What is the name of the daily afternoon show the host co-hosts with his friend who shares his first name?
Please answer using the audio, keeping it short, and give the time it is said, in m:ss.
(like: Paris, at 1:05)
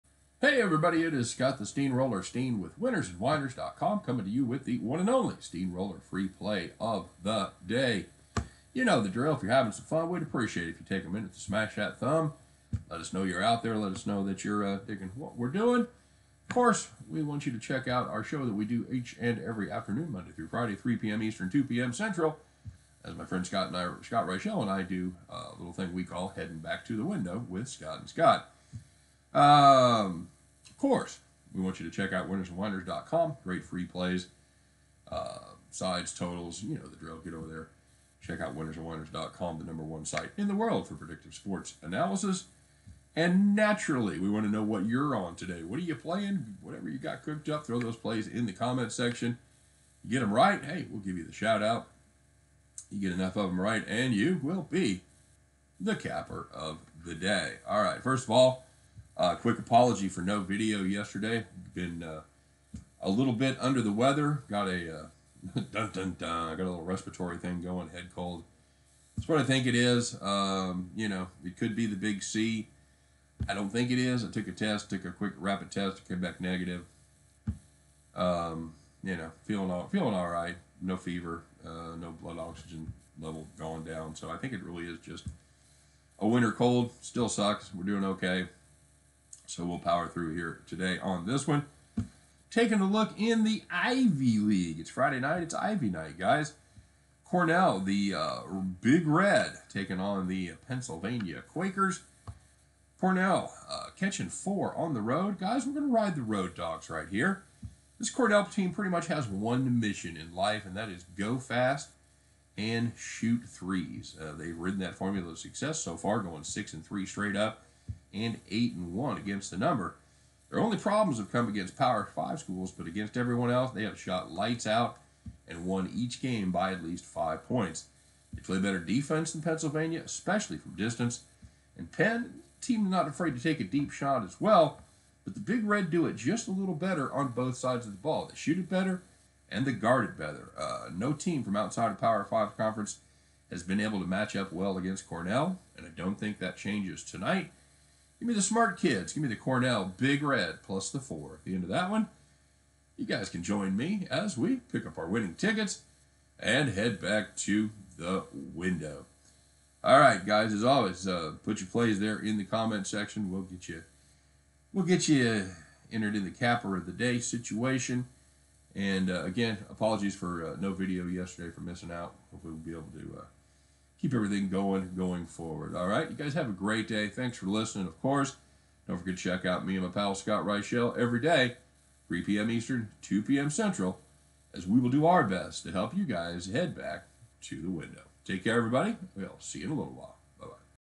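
Heading Back to the Window, at 0:26.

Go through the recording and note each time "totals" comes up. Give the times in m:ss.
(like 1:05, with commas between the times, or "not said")
0:36.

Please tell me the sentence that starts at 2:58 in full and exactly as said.
Don't forget to check out me and my pal Scott Reichel every day, 3 p.m.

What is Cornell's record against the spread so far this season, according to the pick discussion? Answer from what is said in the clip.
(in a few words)
8 and 1.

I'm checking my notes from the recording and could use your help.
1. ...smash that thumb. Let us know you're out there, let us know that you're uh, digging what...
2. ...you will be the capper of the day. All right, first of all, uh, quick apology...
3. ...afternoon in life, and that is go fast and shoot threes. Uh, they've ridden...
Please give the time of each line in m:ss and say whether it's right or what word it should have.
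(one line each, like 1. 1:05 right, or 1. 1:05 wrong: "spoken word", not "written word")
1. 0:11 right
2. 0:54 right
3. 1:49 wrong: "mission", not "afternoon".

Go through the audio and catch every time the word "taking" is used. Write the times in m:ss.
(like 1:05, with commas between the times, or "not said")
1:32, 1:39.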